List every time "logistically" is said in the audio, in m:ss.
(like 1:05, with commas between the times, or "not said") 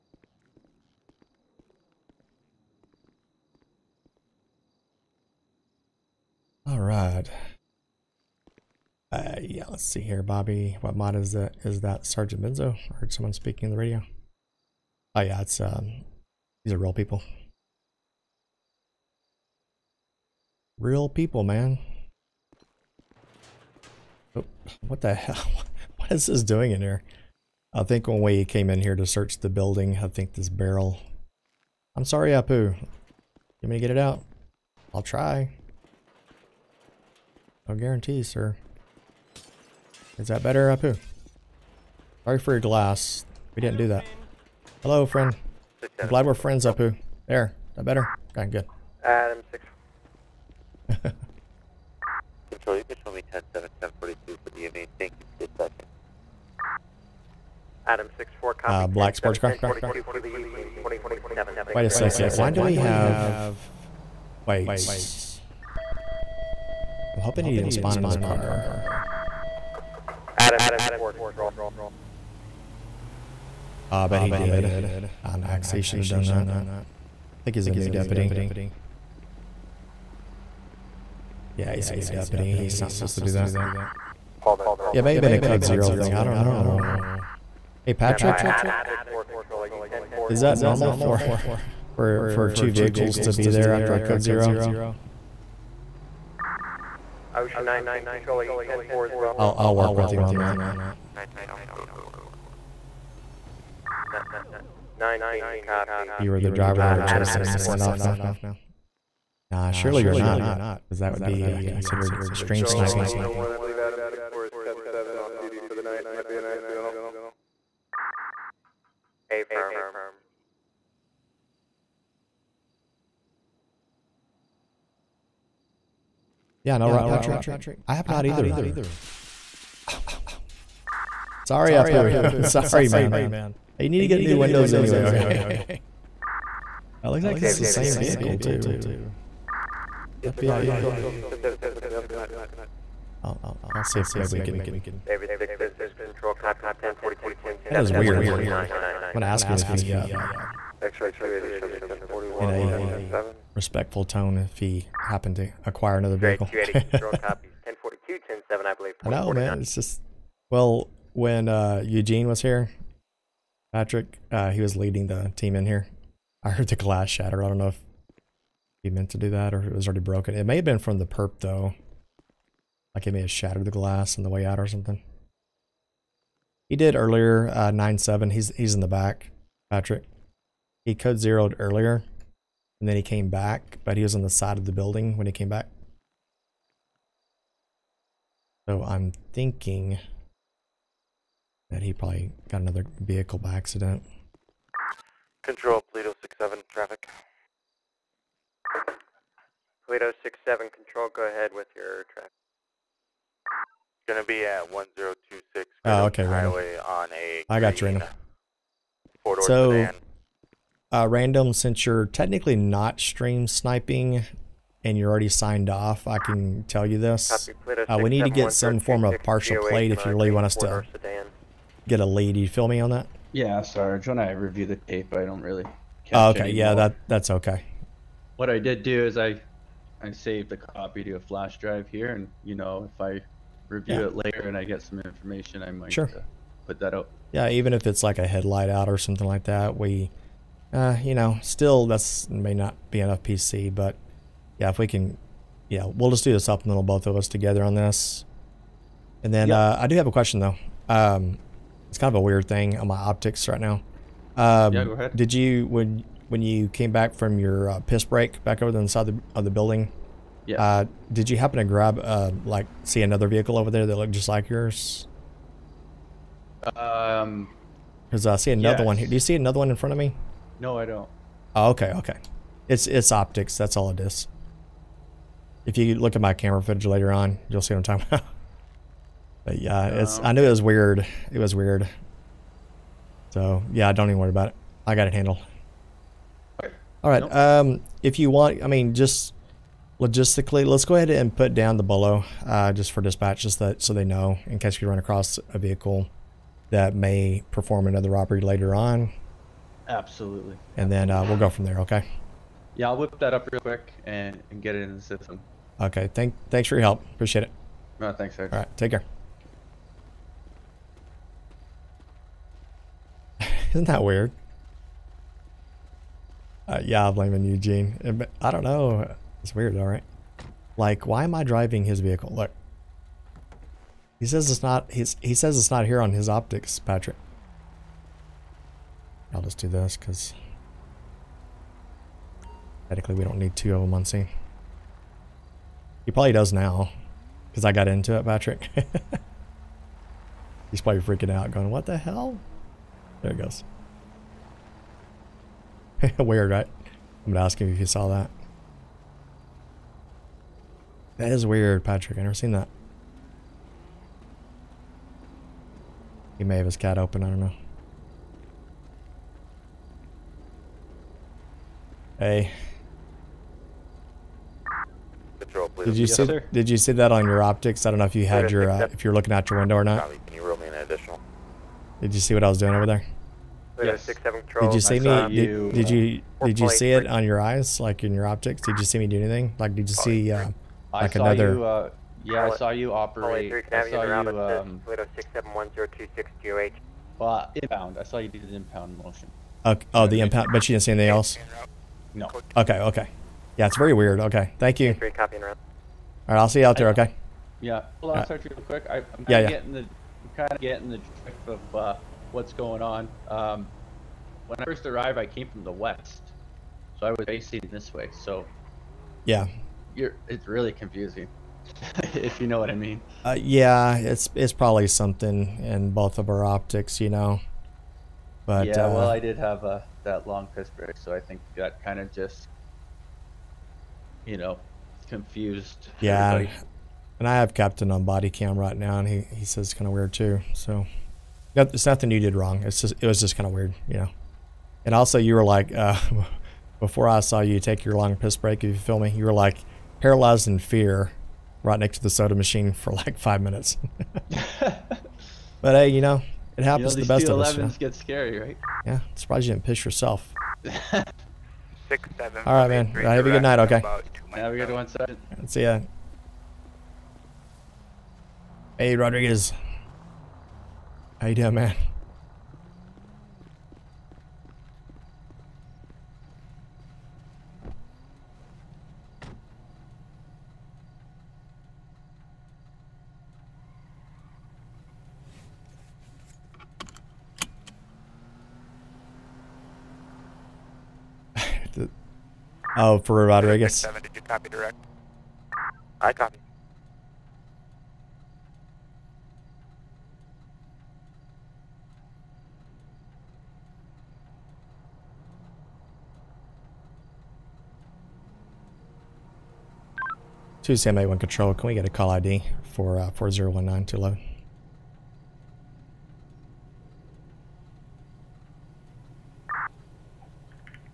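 4:49.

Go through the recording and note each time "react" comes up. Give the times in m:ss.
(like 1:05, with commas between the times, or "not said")
not said.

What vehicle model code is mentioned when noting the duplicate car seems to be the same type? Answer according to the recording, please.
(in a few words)
FPIU.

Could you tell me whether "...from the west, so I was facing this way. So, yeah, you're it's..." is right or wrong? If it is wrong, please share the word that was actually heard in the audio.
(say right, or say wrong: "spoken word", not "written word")
right.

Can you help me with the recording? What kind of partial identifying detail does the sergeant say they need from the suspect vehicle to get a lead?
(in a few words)
Partial plate.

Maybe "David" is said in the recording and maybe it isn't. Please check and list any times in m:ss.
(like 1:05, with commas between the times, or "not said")
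2:25.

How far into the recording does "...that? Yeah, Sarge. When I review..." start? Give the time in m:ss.
3:42.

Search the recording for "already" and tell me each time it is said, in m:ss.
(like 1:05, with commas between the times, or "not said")
2:49, 3:35.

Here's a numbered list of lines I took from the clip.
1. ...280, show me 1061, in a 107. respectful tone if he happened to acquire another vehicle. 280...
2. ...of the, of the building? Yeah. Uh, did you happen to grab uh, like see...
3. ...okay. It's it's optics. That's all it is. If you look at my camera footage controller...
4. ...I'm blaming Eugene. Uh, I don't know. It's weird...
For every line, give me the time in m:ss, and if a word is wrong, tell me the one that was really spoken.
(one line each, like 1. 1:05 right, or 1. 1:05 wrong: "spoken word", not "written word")
1. 2:31 wrong: "1041", not "1061"
2. 4:19 right
3. 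4:31 wrong: "later", not "controller"
4. 5:17 right.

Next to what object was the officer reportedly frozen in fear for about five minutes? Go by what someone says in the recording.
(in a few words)
Soda machine.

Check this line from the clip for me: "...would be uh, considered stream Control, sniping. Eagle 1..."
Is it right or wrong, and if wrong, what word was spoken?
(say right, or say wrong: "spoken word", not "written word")
right.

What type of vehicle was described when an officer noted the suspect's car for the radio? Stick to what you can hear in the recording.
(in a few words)
Black sports car.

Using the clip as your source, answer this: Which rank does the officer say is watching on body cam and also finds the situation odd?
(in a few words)
Captain.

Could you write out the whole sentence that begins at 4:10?
Um, it's kind of a weird thing on my optics right now.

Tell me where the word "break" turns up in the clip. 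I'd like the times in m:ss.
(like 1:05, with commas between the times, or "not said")
4:18, 7:00, 7:18.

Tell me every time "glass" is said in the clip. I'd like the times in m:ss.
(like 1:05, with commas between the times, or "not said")
0:42, 2:46, 2:53.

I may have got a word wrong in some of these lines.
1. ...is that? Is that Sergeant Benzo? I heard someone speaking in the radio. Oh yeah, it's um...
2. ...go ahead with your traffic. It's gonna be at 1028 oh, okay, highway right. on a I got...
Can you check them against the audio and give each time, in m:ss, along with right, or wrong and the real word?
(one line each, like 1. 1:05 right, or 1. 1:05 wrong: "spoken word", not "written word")
1. 0:11 right
2. 3:21 wrong: "1026", not "1028".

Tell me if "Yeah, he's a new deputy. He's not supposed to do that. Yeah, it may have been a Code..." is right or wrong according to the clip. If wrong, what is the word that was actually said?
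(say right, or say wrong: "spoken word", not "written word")
right.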